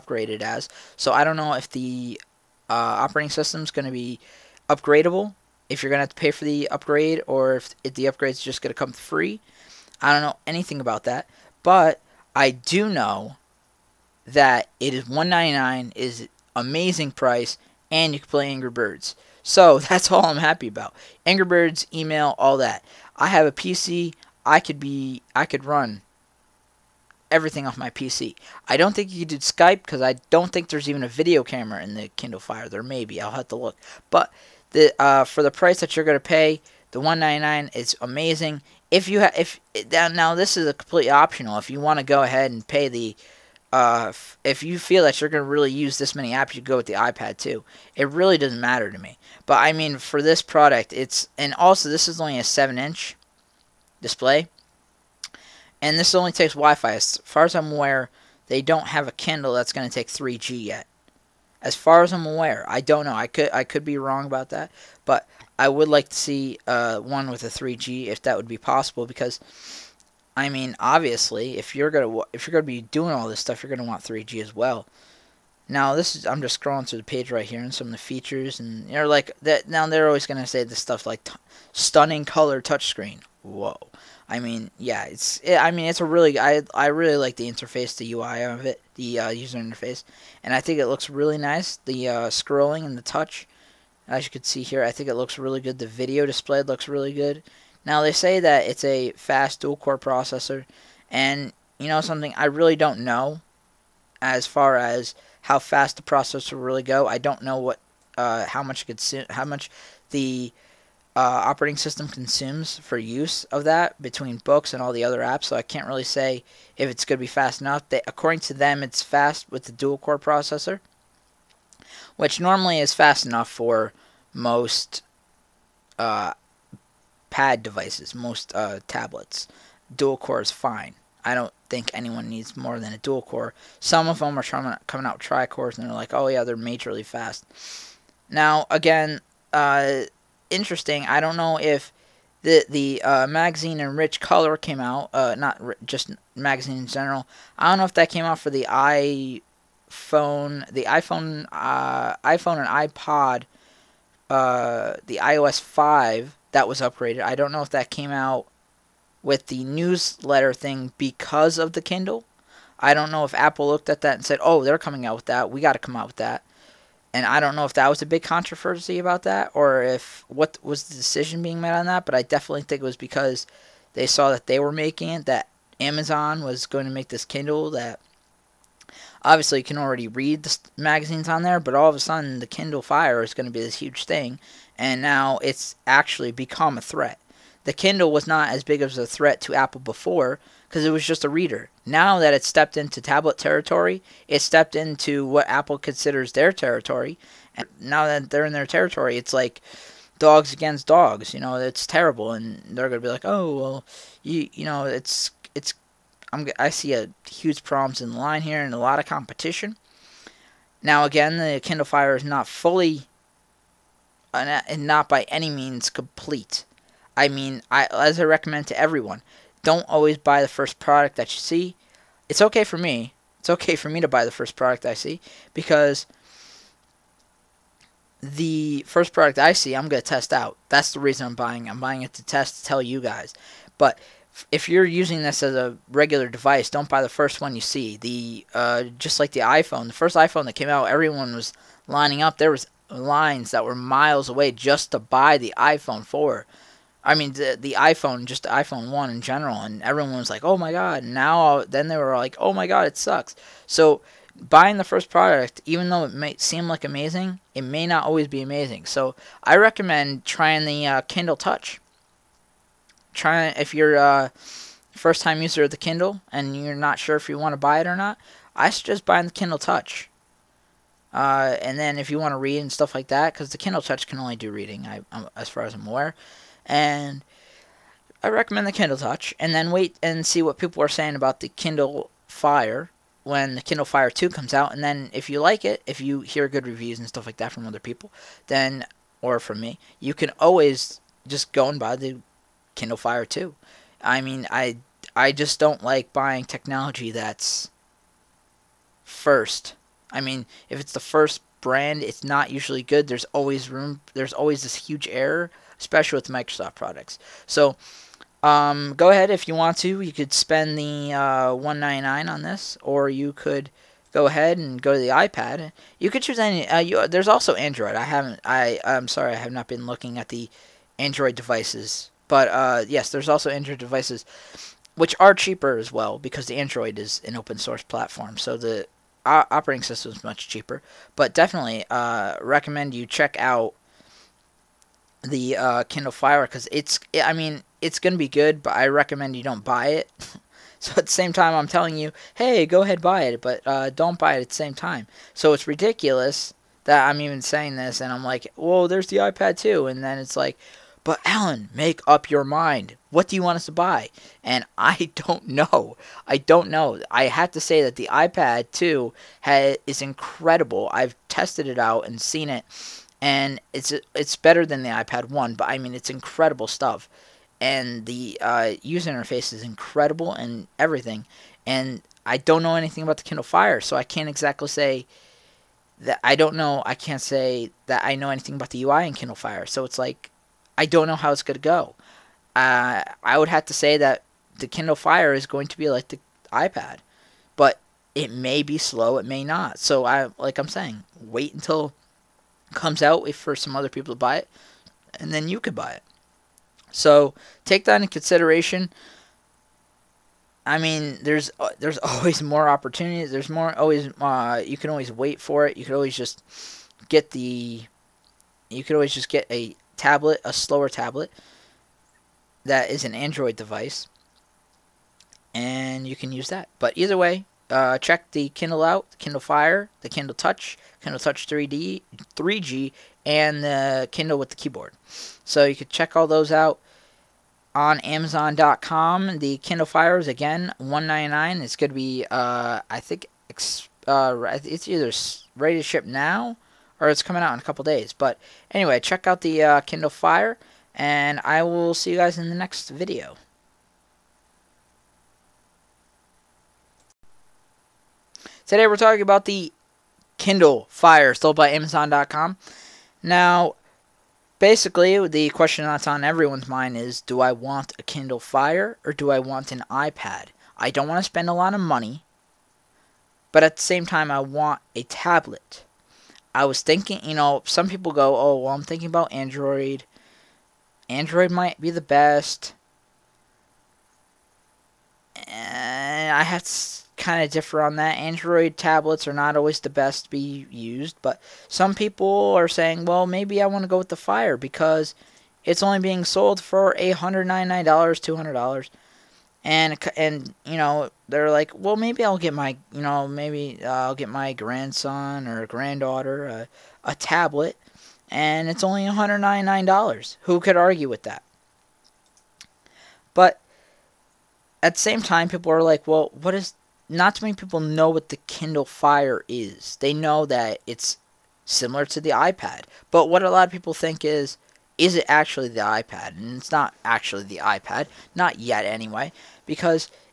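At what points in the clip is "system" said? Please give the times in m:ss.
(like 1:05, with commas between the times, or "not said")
0:03, 1:51, 5:29.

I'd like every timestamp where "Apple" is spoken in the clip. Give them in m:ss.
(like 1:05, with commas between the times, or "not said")
2:43, 3:09, 3:15.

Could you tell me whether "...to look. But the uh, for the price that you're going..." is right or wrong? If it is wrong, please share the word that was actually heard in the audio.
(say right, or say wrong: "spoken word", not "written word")
right.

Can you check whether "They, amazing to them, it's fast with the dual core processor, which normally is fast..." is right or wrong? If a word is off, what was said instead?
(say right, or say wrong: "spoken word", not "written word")
wrong: "according", not "amazing".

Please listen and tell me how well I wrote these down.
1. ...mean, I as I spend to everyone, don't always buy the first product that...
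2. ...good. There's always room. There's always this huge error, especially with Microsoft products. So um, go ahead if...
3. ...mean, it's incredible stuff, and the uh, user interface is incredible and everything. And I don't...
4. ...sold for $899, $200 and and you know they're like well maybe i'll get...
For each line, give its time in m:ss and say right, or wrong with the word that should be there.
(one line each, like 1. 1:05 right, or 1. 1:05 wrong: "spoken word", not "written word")
1. 3:37 wrong: "recommend", not "spend"
2. 5:02 right
3. 6:05 right
4. 8:06 right.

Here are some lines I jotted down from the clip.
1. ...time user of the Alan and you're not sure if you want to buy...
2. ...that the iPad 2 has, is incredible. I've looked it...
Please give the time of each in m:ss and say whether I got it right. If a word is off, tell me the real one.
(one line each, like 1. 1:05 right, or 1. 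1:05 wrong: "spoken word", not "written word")
1. 4:25 wrong: "Kindle", not "Alan"
2. 5:57 wrong: "tested", not "looked".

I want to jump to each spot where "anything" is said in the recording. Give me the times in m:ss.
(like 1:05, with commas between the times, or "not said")
0:10, 6:12, 6:18.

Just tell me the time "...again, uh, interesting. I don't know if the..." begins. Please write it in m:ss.
2:18.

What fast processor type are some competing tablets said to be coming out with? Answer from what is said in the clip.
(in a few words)
tri cores.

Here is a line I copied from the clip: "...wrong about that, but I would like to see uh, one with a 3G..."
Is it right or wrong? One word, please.
right.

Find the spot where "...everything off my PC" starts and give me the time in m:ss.
0:27.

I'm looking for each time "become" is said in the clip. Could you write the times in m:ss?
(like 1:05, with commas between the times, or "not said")
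3:06.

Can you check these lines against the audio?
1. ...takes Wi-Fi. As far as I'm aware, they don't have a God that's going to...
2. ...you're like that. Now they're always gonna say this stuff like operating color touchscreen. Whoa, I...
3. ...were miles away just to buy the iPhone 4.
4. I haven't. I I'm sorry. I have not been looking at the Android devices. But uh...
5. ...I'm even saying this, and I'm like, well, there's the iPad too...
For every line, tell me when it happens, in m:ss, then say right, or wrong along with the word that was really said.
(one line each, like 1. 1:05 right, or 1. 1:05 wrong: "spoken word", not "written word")
1. 0:56 wrong: "Kindle", not "God"
2. 1:18 wrong: "stunning", not "operating"
3. 4:03 right
4. 5:17 right
5. 5:47 right.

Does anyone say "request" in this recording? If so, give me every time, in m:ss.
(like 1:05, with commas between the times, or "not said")
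not said.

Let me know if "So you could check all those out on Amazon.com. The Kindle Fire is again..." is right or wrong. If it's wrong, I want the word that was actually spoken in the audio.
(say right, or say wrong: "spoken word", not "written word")
right.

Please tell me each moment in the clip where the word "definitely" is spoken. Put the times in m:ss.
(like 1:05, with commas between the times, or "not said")
2:52, 5:31.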